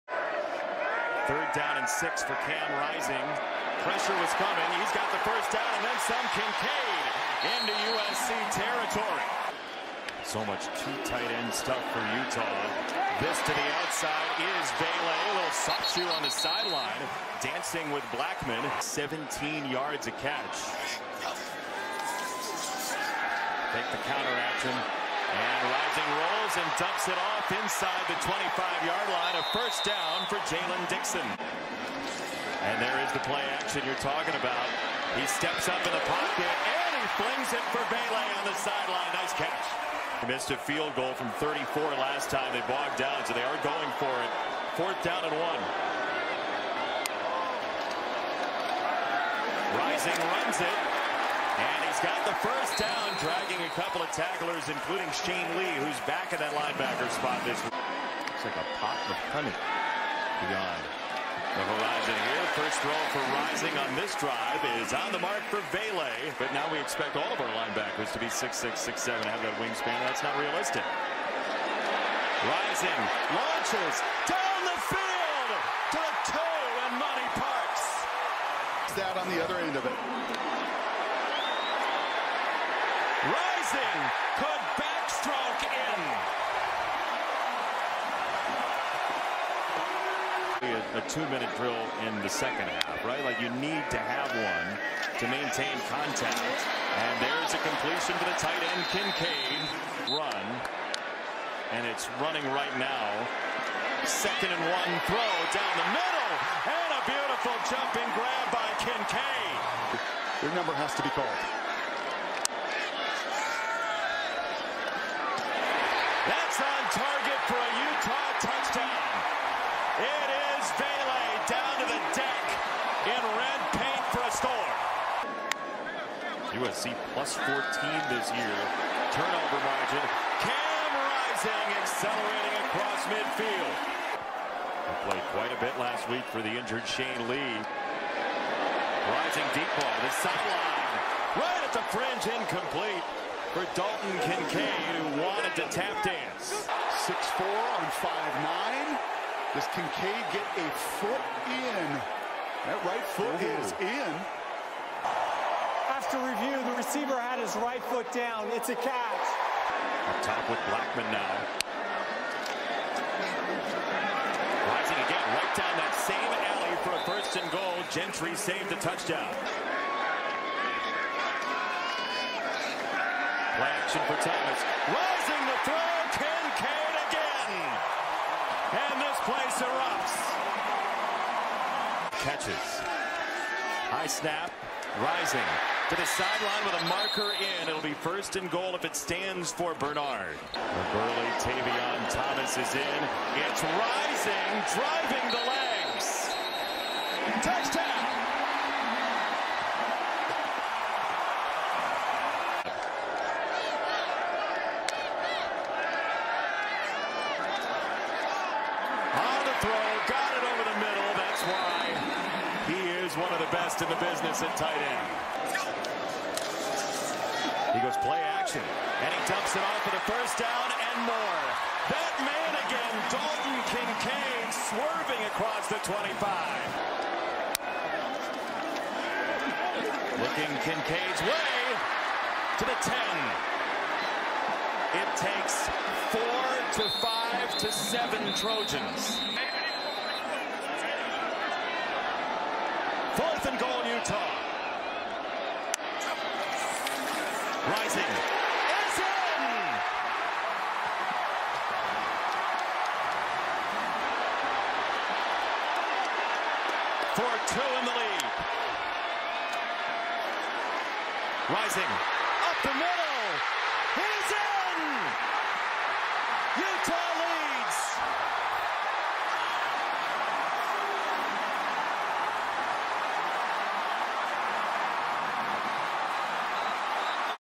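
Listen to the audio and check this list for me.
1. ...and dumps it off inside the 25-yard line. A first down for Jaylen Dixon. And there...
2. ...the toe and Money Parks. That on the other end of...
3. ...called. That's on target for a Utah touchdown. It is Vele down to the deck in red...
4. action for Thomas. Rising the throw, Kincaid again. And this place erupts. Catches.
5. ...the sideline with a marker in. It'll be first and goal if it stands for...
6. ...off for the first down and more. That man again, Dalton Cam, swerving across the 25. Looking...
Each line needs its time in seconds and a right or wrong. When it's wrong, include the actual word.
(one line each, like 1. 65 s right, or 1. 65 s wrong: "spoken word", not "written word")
1. 26 s right
2. 76 s right
3. 111 s right
4. 173 s right
5. 185 s right
6. 219 s wrong: "Kincaid", not "Cam".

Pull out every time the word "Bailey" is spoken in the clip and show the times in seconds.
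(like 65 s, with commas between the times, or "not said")
14 s, 37 s.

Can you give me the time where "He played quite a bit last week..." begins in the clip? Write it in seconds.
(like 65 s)
134 s.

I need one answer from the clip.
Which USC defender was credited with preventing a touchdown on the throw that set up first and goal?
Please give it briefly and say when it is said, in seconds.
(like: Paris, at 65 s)
Gentry, at 167 s.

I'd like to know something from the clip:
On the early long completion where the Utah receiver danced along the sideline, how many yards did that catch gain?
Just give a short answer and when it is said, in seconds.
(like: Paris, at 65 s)
17, at 18 s.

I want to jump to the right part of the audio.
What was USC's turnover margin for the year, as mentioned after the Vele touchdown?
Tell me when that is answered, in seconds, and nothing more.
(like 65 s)
127 s.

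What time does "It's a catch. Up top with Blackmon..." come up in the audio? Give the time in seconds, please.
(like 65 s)
158 s.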